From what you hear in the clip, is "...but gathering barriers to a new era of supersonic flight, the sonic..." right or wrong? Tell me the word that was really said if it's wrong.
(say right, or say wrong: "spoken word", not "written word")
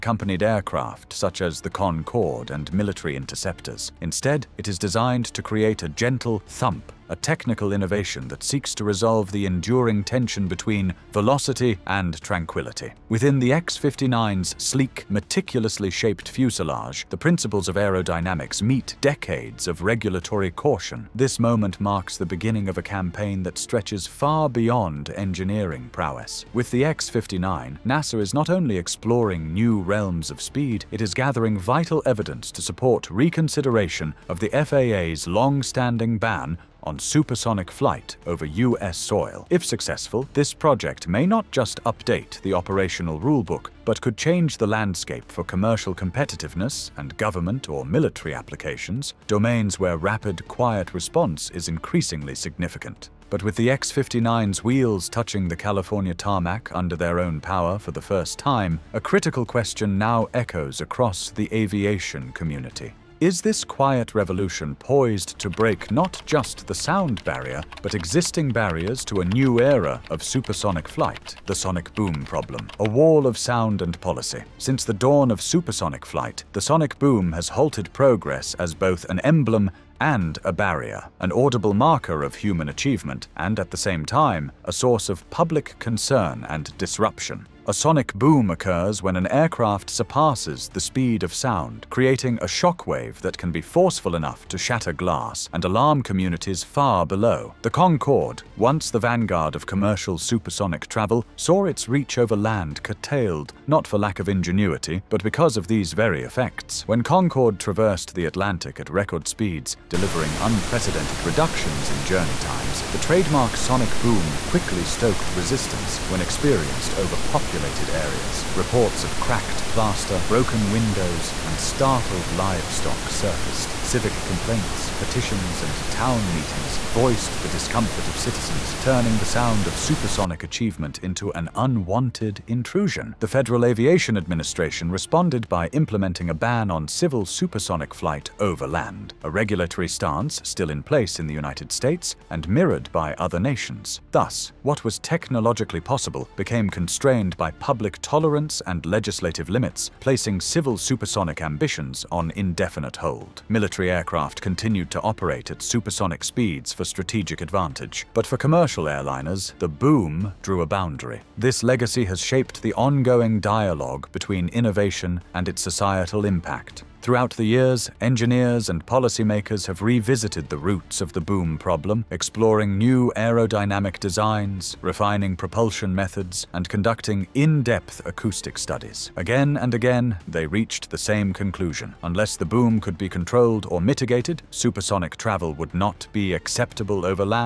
wrong: "existing", not "gathering".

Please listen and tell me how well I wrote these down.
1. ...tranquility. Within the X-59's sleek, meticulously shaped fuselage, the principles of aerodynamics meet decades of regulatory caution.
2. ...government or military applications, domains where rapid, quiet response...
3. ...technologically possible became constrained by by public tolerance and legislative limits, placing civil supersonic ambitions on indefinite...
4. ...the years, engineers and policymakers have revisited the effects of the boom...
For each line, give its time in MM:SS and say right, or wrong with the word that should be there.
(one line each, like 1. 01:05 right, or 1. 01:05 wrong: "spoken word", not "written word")
1. 00:12 right
2. 00:47 right
3. 02:24 right
4. 02:47 wrong: "roots", not "effects".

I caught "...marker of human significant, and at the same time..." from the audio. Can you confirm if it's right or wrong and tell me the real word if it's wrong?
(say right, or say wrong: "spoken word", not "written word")
wrong: "achievement", not "significant".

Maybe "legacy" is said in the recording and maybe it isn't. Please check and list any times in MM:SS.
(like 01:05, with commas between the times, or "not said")
02:41.